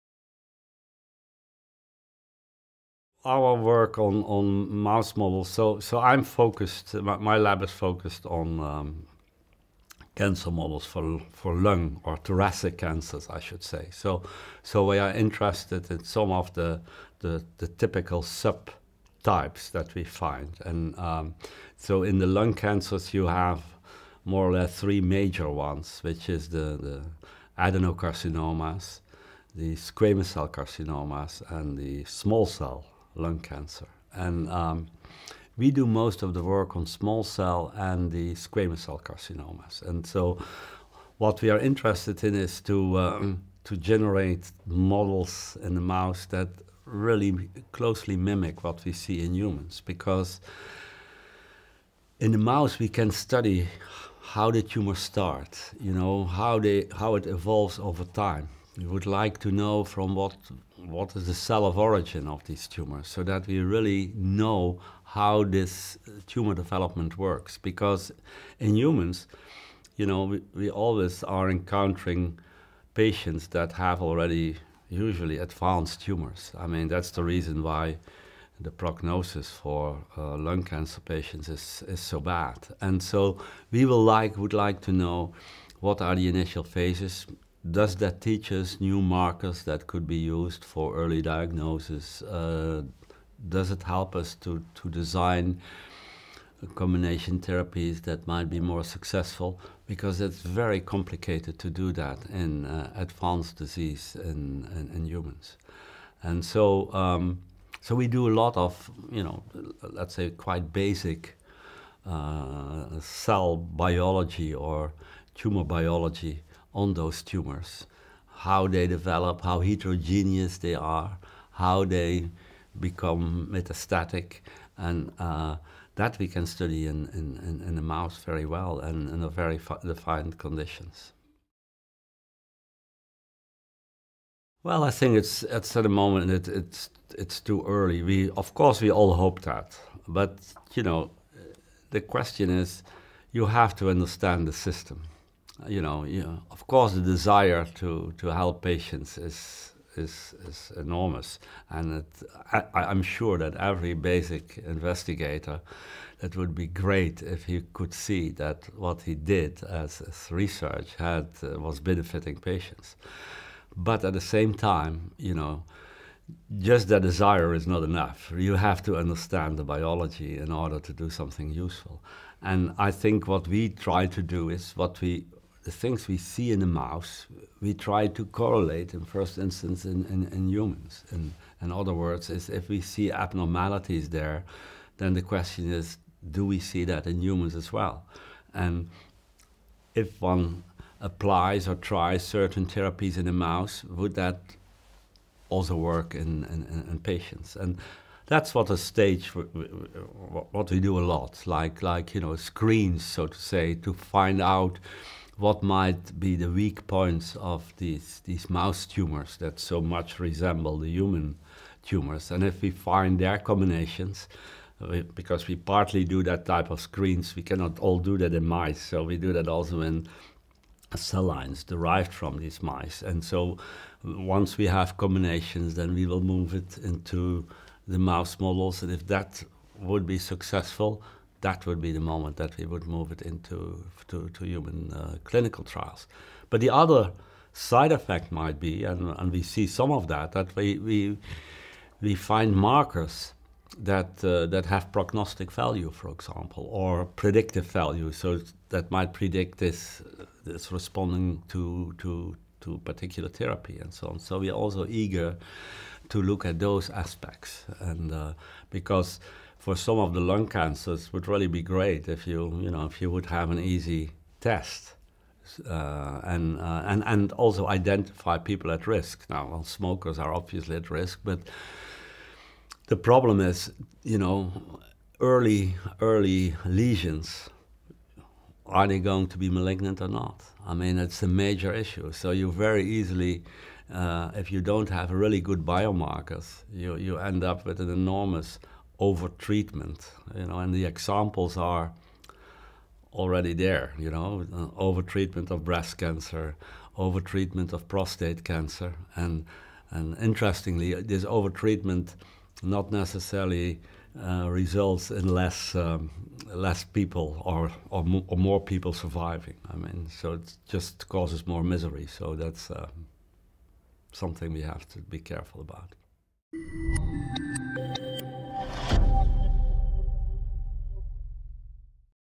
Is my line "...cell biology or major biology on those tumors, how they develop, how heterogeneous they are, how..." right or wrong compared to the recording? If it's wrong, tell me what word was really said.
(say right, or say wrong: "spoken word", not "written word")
wrong: "tumor", not "major".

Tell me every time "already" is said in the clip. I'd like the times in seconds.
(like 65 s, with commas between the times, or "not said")
74 s, 293 s.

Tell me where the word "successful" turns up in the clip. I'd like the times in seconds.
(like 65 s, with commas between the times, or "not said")
98 s, 230 s.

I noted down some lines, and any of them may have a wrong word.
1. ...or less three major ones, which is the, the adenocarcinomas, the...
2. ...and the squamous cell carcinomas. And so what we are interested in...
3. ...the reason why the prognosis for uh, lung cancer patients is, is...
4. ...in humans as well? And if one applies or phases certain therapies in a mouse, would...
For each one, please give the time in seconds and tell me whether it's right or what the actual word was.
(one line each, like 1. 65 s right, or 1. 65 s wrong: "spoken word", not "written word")
1. 24 s right
2. 37 s right
3. 77 s right
4. 187 s wrong: "tries", not "phases".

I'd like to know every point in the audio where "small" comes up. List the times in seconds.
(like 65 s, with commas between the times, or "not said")
32 s, 36 s.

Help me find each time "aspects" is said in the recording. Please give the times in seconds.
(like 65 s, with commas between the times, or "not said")
256 s.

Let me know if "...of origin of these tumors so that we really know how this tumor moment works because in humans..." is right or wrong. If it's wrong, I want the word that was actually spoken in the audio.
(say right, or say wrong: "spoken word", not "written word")
wrong: "development", not "moment".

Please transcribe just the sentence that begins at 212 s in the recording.
And if we find their combinations, we, because we partly do that type of screens, we cannot all do that in mice.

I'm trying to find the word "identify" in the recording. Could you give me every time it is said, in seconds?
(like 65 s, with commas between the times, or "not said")
267 s.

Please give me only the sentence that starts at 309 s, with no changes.
I mean, so it just causes more misery.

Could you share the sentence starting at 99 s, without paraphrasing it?
Because it's very complicated to do that in uh, advanced disease in, in, in, humans.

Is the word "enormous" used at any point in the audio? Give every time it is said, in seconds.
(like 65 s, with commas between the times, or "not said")
150 s, 287 s.